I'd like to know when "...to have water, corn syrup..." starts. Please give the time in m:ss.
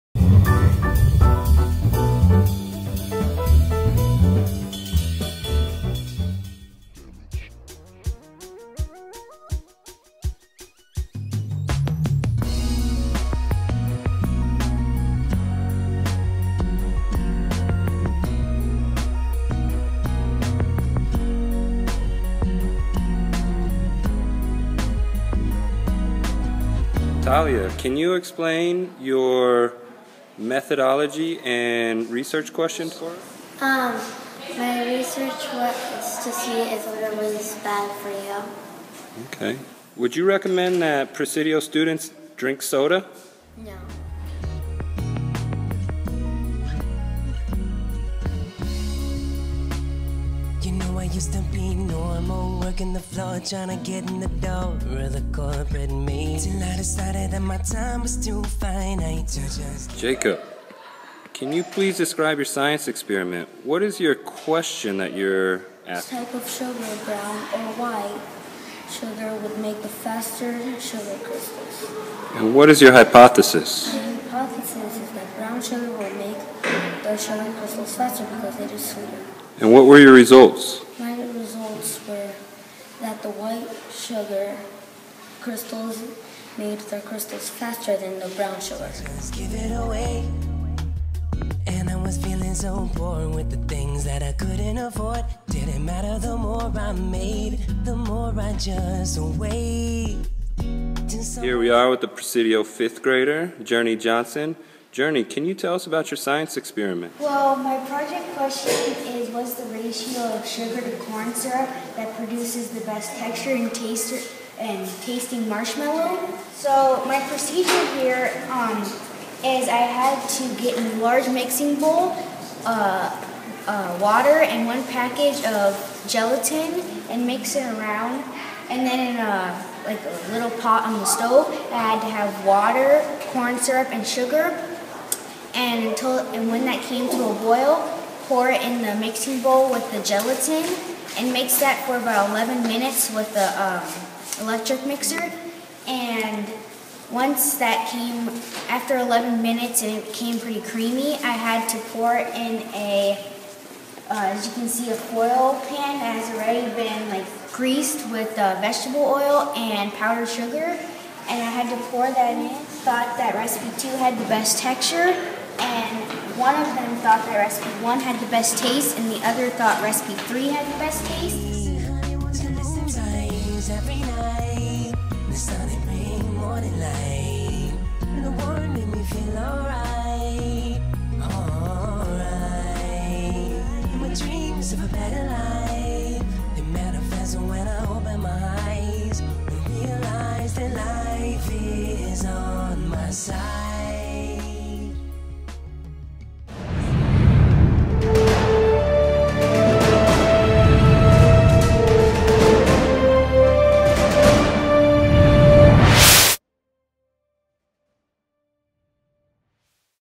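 2:12.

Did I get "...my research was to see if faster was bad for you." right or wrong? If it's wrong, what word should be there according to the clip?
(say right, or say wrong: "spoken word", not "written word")
wrong: "water", not "faster".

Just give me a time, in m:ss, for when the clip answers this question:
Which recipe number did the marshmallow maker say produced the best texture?
2:43.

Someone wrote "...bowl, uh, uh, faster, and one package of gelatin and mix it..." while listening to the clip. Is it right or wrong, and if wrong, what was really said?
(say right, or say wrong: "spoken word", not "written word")
wrong: "water", not "faster".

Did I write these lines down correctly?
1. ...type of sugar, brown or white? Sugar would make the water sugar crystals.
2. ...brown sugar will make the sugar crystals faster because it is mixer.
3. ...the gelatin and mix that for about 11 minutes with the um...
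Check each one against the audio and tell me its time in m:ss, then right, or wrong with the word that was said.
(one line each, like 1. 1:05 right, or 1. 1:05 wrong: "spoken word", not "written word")
1. 1:06 wrong: "faster", not "water"
2. 1:15 wrong: "sweeter", not "mixer"
3. 2:19 right.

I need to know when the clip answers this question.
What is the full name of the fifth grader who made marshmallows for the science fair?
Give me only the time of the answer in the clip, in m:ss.
1:43.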